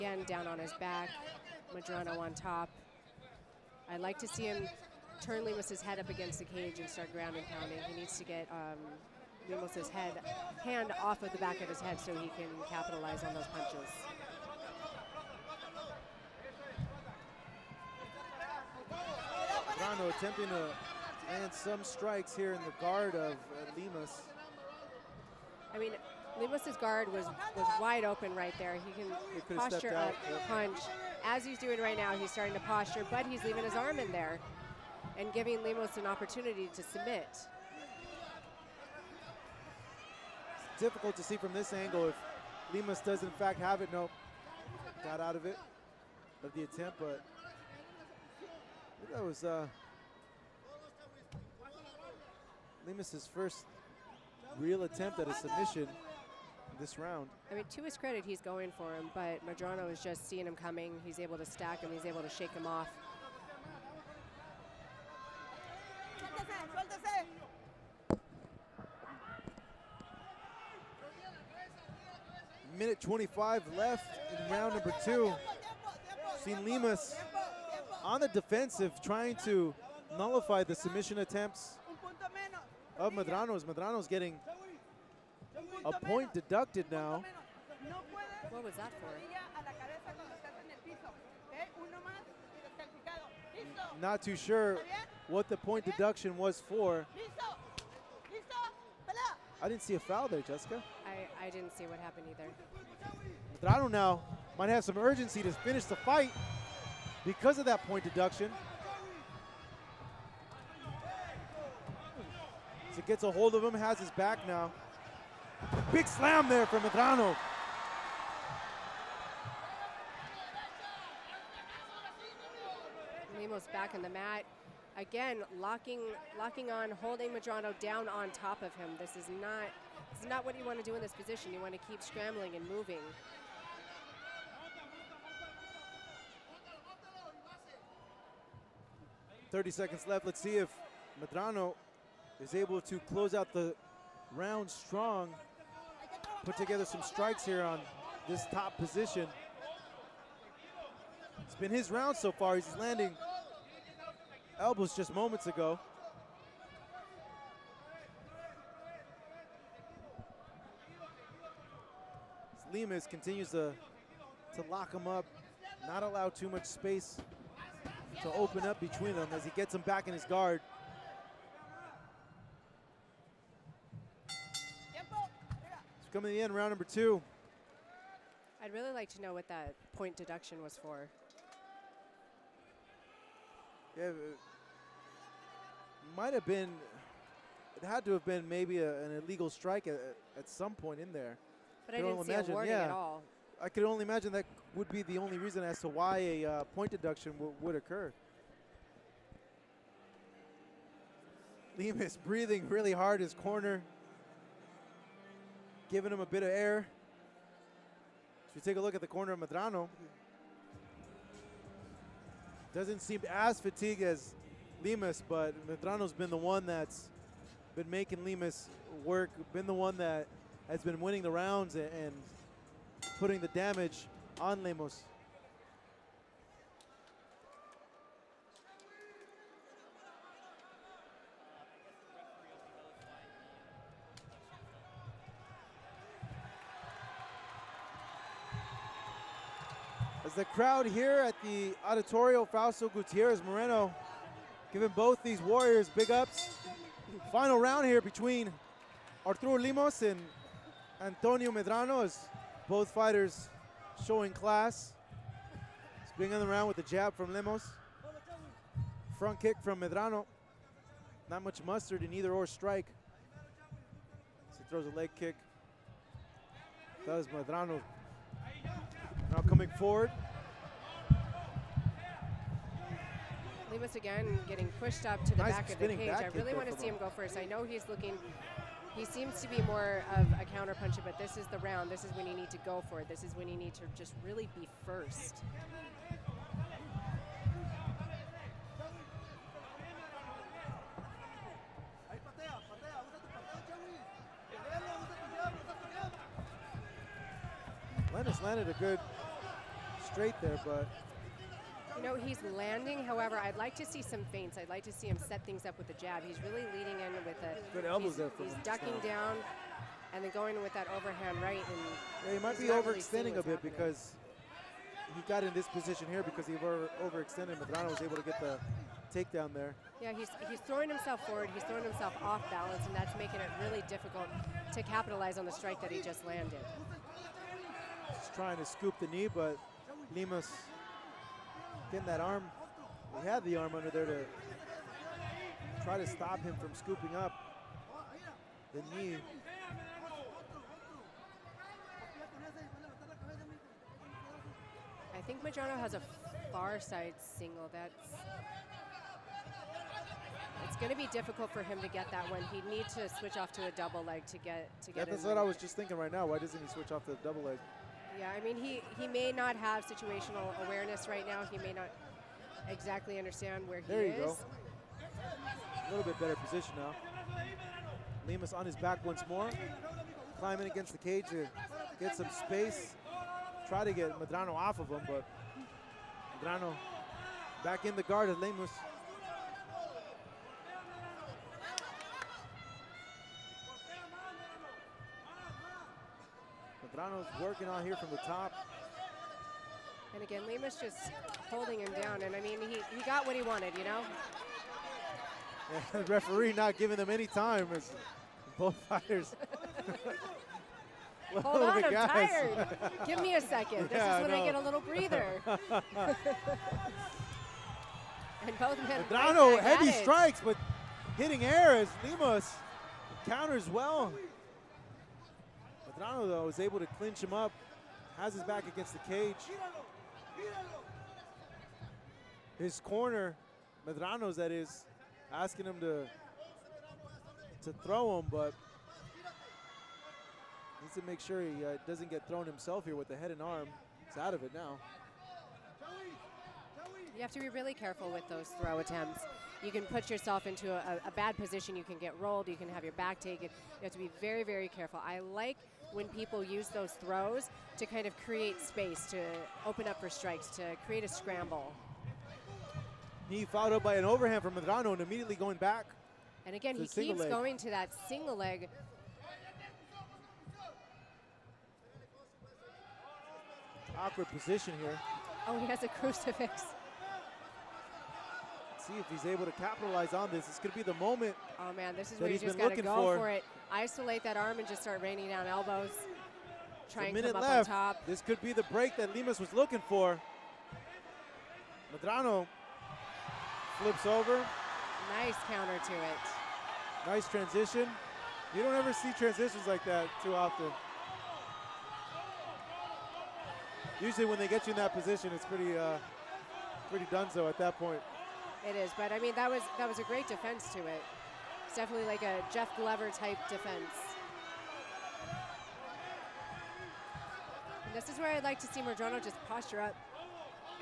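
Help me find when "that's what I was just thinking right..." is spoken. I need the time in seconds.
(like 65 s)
355 s.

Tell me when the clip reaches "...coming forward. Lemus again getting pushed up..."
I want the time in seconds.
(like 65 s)
269 s.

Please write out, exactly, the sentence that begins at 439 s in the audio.
You can put yourself into a, a bad position.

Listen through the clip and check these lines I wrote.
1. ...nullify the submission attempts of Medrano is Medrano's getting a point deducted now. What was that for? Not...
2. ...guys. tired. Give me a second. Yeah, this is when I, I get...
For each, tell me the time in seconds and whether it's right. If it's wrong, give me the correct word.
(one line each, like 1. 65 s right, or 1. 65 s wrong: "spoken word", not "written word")
1. 80 s right
2. 401 s right.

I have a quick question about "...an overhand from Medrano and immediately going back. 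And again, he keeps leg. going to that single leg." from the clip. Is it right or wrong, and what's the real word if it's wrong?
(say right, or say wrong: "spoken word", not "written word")
right.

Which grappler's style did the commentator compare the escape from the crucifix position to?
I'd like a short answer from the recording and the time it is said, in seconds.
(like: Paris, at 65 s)
Jeff Glover, at 502 s.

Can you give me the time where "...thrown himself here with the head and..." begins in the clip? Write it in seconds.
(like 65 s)
432 s.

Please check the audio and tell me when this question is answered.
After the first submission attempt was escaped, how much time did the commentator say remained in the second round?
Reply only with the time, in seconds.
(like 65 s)
72 s.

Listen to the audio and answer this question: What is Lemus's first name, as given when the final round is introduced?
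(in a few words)
Arturo.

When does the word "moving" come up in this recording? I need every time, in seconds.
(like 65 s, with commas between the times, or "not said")
132 s.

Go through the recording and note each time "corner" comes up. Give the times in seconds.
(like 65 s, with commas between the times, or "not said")
203 s, 209 s, 422 s.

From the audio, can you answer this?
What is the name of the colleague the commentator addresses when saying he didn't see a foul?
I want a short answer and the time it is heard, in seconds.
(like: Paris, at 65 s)
Jessica, at 100 s.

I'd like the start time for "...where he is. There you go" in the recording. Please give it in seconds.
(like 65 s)
363 s.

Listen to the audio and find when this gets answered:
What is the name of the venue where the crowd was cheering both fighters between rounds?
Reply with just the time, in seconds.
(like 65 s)
241 s.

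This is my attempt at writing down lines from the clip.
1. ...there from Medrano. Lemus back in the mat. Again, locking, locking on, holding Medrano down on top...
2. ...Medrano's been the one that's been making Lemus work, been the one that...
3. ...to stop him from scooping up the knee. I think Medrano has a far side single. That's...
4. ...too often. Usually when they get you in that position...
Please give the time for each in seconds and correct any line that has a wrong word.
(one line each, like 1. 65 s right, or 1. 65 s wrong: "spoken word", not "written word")
1. 116 s right
2. 215 s right
3. 335 s right
4. 490 s right.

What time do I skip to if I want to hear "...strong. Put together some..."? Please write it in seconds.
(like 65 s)
144 s.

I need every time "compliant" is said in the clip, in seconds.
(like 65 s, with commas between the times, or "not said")
not said.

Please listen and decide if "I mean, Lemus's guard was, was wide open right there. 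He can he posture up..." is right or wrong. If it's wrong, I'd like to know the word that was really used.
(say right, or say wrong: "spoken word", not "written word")
right.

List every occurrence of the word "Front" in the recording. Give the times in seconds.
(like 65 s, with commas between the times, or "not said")
259 s.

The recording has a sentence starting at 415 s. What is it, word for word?
Medrano, though, is able to clinch him up, has his back against the cage.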